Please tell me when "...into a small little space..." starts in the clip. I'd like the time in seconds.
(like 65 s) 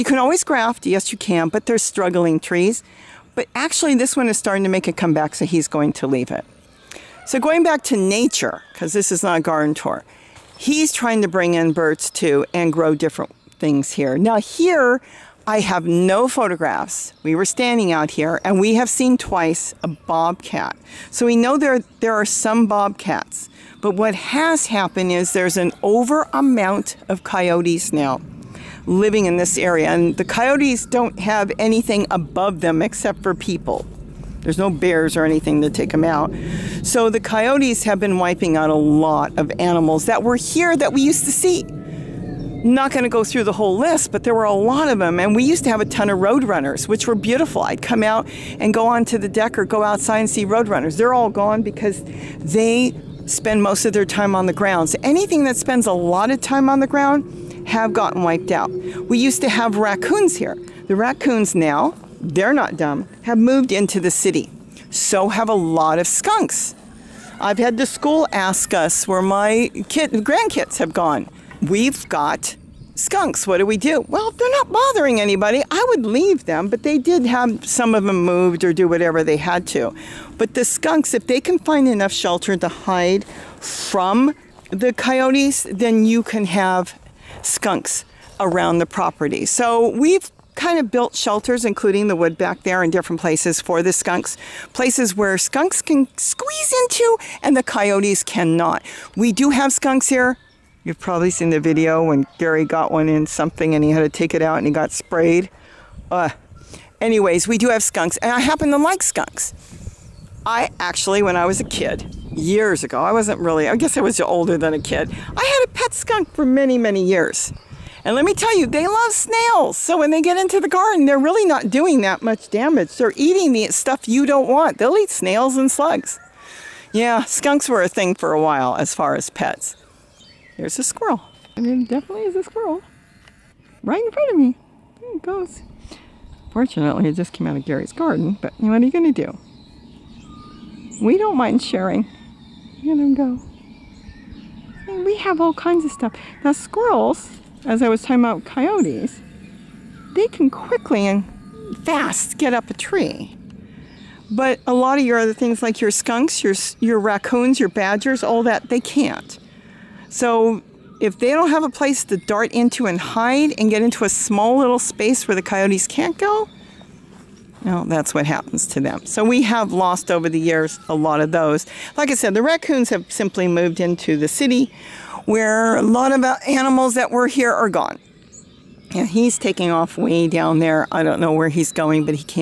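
163 s.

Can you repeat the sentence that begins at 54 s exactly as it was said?
So anything that spends a lot of time on the ground have gotten wiped out.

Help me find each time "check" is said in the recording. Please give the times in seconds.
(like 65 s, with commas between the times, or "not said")
not said.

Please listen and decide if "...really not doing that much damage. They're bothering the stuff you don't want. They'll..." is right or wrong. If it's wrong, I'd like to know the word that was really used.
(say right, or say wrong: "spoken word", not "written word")
wrong: "eating", not "bothering".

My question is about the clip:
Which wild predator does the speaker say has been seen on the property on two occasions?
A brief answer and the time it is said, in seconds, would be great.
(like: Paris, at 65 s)
Bobcat, at 19 s.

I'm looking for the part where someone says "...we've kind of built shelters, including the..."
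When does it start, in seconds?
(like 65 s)
89 s.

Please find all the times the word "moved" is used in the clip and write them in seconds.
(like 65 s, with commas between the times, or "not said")
63 s, 78 s, 173 s.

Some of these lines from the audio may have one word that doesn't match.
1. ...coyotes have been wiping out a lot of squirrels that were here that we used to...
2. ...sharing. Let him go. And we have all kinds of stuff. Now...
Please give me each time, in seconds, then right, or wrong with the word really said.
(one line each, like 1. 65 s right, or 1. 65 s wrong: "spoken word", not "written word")
1. 37 s wrong: "animals", not "squirrels"
2. 141 s right.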